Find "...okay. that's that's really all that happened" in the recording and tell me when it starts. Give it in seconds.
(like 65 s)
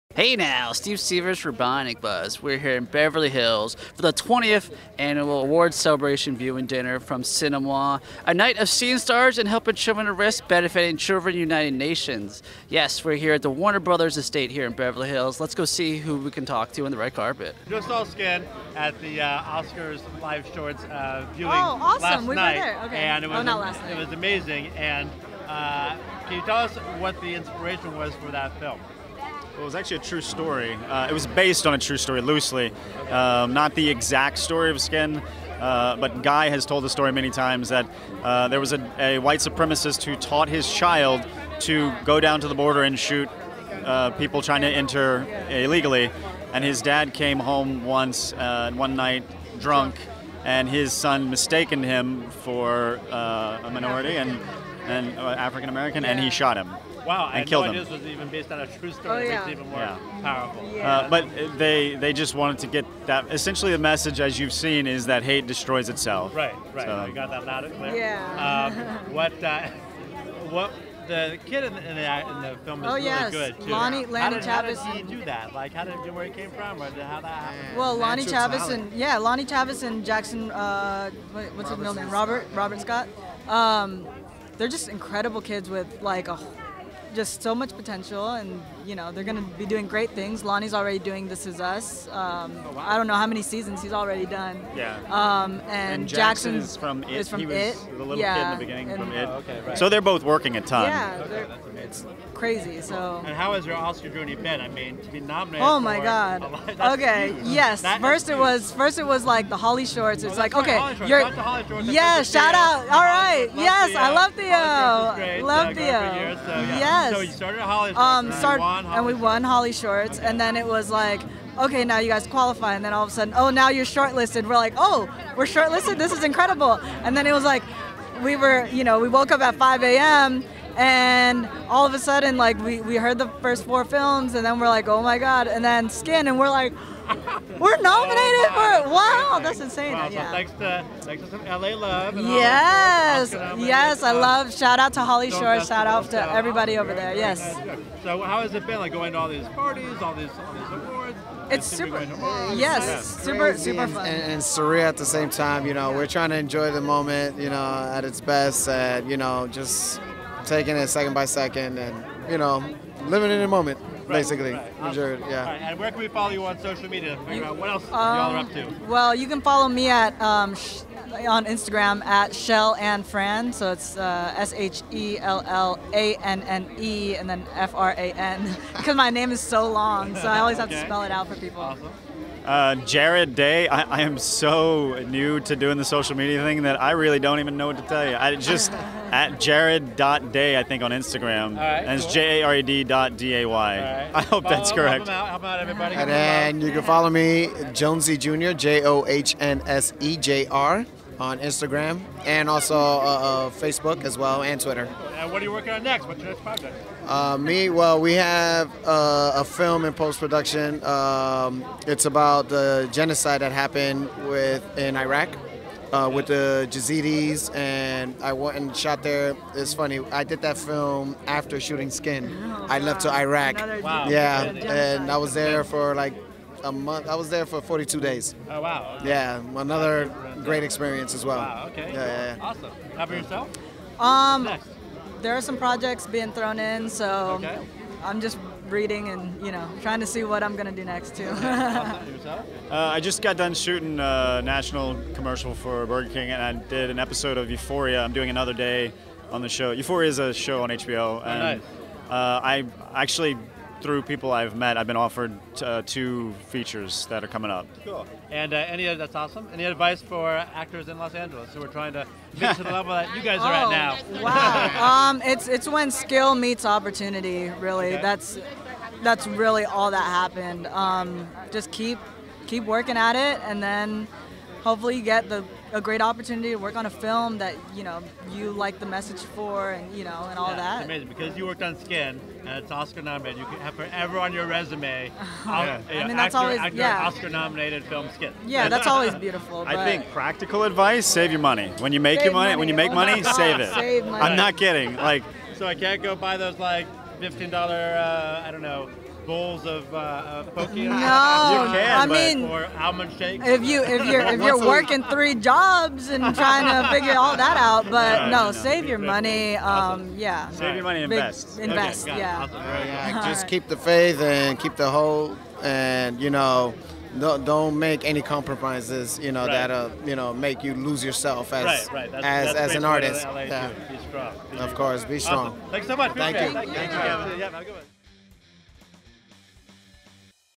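267 s.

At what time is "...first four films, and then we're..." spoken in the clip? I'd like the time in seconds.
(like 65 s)
133 s.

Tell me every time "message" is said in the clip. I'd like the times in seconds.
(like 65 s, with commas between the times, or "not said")
63 s, 278 s.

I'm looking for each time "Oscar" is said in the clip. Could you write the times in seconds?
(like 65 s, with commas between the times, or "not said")
19 s, 103 s, 282 s, 287 s.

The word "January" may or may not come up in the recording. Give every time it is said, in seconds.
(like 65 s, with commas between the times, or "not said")
not said.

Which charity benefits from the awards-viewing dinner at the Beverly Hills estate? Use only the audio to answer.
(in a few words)
Children United Nations.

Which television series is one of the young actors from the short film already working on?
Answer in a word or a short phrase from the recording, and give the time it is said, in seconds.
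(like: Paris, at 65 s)
This Is Us, at 91 s.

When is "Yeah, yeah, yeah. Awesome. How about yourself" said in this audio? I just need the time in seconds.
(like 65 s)
231 s.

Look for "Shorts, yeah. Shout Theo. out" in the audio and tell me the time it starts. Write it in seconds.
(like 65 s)
111 s.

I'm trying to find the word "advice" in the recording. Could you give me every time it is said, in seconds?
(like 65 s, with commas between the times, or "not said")
259 s, 290 s.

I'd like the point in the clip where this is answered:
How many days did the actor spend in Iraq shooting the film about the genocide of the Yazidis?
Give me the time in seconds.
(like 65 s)
227 s.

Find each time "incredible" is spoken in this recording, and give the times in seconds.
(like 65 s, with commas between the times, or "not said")
84 s, 126 s.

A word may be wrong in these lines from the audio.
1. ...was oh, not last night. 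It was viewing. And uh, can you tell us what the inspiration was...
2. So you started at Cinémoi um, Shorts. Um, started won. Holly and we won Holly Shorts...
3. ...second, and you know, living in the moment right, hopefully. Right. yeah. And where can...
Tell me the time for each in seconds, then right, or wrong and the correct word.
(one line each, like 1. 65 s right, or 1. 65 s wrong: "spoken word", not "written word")
1. 23 s wrong: "amazing", not "viewing"
2. 117 s wrong: "Holly", not "Cinémoi"
3. 161 s wrong: "basically", not "hopefully".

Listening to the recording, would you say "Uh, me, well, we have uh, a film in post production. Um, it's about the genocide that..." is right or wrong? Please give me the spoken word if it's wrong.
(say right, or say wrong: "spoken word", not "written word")
right.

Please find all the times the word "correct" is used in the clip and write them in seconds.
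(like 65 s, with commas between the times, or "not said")
194 s.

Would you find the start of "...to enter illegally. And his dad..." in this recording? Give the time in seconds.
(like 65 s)
44 s.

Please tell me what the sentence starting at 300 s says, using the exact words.
No, you can, I but, mean, or almond shakes.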